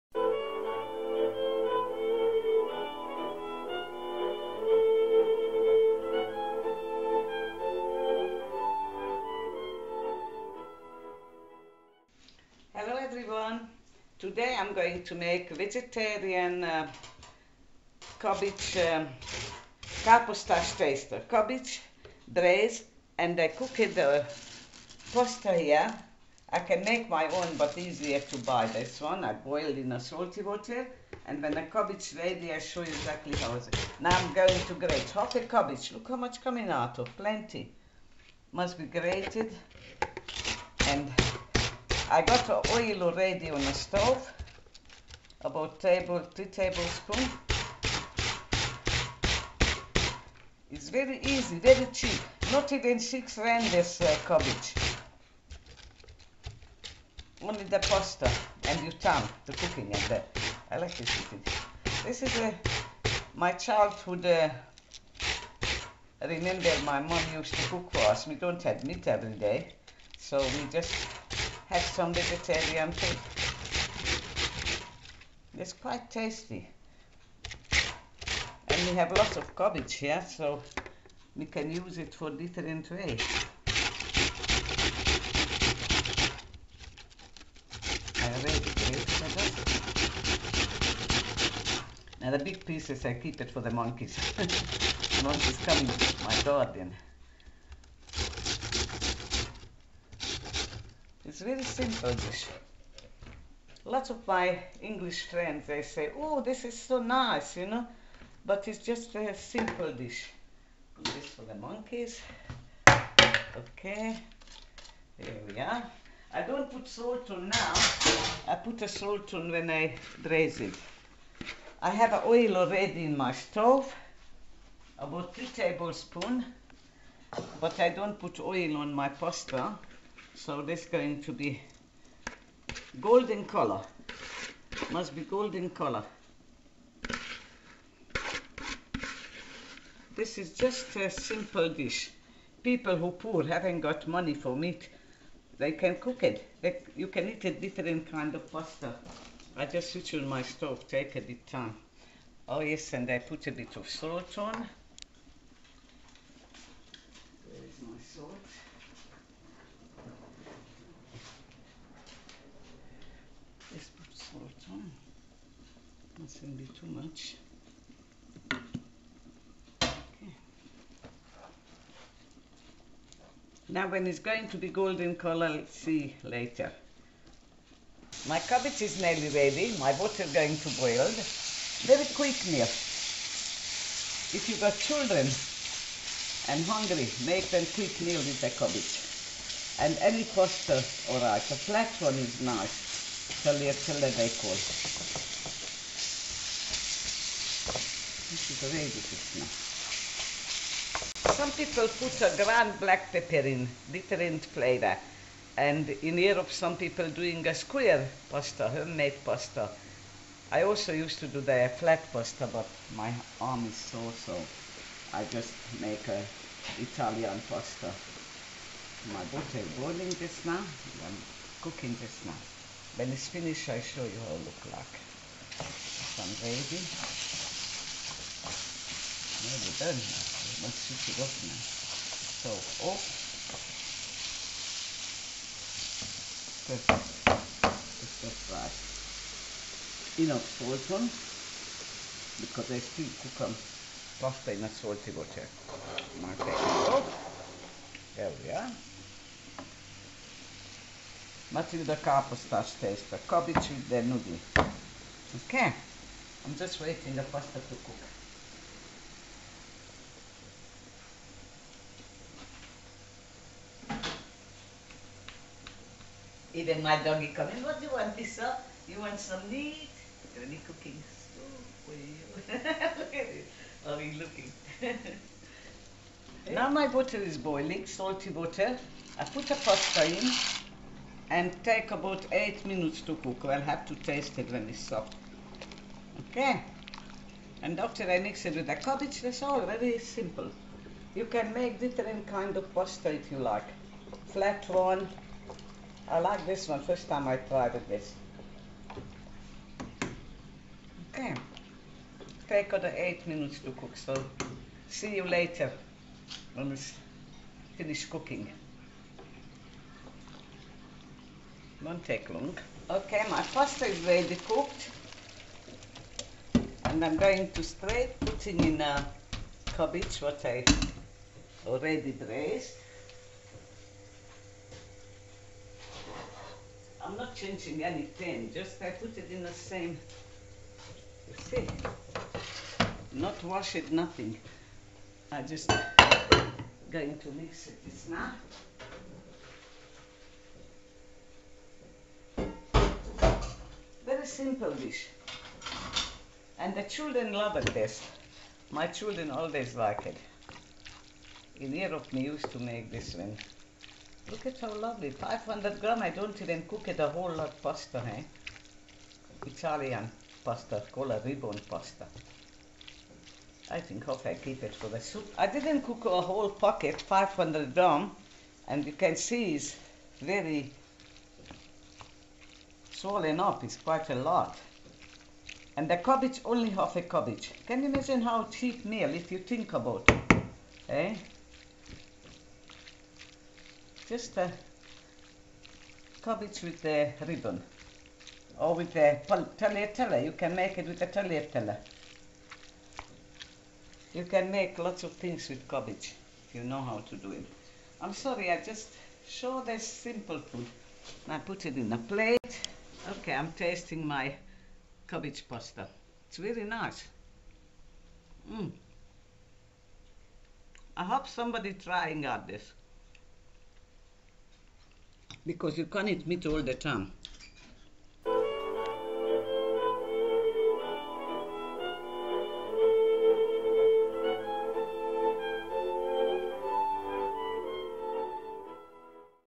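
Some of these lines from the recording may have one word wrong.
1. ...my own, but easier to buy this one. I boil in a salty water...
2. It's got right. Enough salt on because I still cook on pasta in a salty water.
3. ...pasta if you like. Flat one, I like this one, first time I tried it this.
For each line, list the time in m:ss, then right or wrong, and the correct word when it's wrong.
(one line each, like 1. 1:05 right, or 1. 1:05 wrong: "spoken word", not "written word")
1. 0:27 right
2. 3:58 right
3. 4:52 right.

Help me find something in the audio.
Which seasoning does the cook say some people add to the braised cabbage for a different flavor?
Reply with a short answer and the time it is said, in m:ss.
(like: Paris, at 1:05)
Black pepper, at 3:22.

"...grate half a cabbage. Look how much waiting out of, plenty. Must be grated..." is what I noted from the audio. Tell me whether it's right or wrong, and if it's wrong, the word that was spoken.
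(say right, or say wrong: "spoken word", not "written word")
wrong: "coming", not "waiting".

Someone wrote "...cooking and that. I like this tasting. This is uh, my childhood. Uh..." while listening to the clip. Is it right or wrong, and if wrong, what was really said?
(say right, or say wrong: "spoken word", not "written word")
wrong: "cooking", not "tasting".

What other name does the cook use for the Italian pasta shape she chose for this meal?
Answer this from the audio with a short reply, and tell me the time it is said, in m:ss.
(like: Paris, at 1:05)
Ribbon pasta, at 6:01.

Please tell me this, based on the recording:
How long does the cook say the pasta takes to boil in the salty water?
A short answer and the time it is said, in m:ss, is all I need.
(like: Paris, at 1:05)
8 minutes, at 4:42.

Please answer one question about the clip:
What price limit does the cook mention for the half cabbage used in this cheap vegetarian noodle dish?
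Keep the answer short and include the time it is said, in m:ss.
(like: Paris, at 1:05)
Not even 6 rand, at 0:52.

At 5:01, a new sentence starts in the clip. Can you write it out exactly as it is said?
Okay, take other eight minutes to cook, so see you later when we finish cooking.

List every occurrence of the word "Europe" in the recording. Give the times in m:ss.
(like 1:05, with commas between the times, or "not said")
3:26, 5:51.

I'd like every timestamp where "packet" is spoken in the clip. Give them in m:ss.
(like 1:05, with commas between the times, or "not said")
6:06.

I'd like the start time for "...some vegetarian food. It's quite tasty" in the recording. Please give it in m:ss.
1:11.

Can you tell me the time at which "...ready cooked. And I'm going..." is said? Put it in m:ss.
5:14.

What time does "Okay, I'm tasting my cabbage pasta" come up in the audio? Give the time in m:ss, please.
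6:43.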